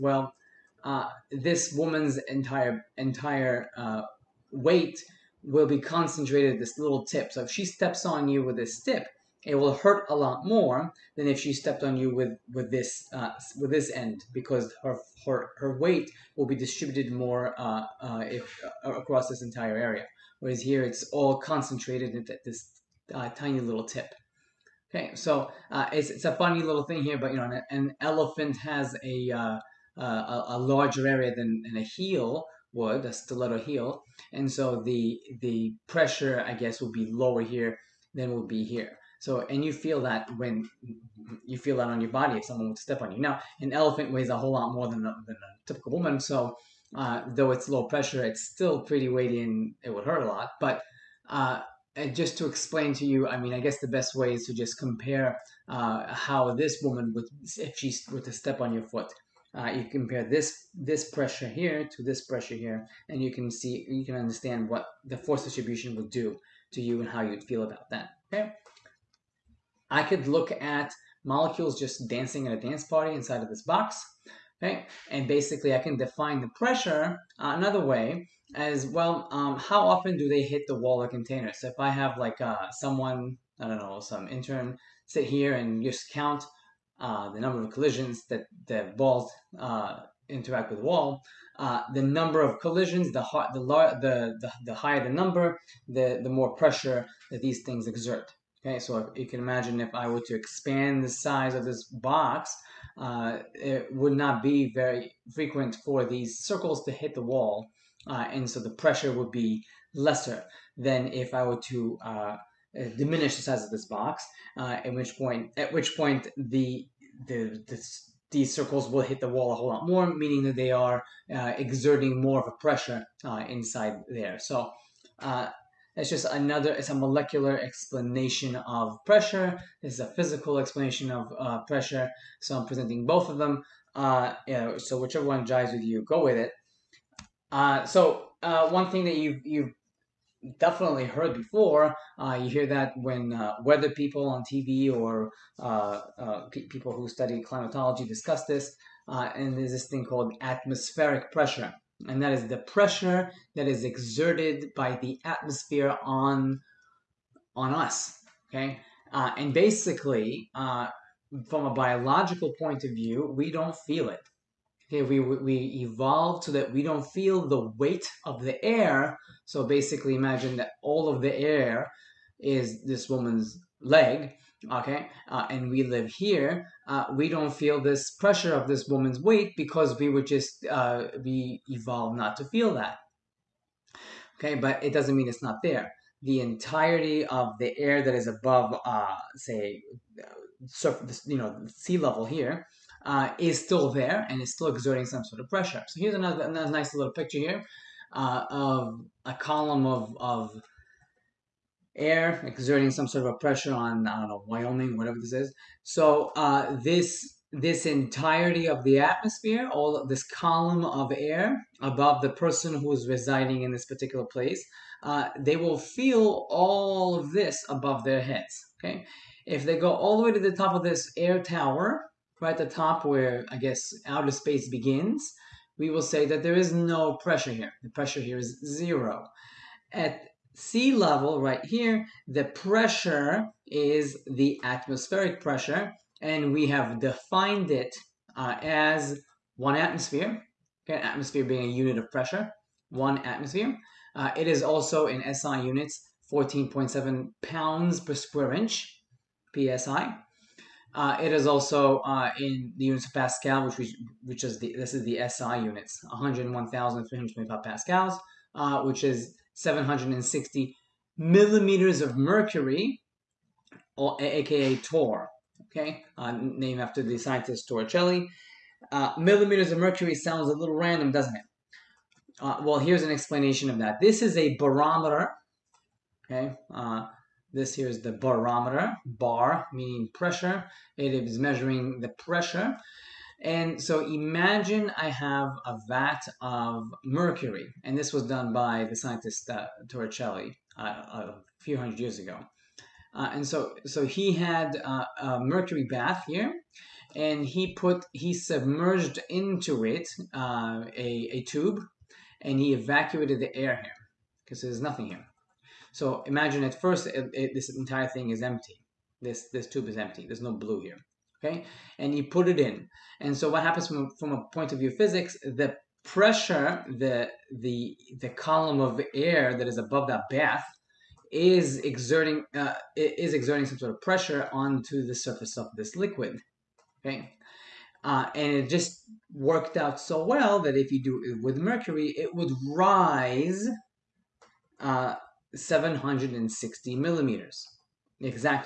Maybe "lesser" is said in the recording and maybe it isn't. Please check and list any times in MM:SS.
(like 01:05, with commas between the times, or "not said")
01:49.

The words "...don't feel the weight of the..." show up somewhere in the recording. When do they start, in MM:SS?
02:46.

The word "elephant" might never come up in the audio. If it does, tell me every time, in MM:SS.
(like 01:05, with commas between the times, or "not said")
00:28, 00:43.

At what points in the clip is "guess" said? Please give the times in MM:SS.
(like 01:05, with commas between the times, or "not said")
00:36, 00:53, 03:43.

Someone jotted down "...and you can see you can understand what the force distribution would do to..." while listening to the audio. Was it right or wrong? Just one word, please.
right.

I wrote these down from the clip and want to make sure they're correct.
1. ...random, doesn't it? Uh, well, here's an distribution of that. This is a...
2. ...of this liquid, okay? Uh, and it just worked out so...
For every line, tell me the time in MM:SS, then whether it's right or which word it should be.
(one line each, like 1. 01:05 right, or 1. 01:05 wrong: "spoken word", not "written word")
1. 04:30 wrong: "explanation", not "distribution"
2. 05:25 right.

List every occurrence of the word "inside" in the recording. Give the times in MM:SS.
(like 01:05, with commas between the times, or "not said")
01:13, 02:03.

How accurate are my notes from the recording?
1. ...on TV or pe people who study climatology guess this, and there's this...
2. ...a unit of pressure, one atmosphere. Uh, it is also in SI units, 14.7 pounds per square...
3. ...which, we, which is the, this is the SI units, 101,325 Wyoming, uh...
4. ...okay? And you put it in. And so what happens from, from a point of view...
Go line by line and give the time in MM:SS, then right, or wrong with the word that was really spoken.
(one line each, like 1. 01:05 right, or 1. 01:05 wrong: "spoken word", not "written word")
1. 02:24 wrong: "discuss", not "guess"
2. 04:01 right
3. 04:13 wrong: "Pascals", not "Wyoming"
4. 05:11 right.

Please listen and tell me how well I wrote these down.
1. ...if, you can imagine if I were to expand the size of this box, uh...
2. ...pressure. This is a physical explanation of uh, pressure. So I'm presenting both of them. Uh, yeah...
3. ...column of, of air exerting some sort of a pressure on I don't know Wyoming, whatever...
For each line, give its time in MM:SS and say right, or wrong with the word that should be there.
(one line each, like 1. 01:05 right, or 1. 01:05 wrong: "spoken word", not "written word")
1. 01:38 right
2. 02:09 right
3. 03:19 right.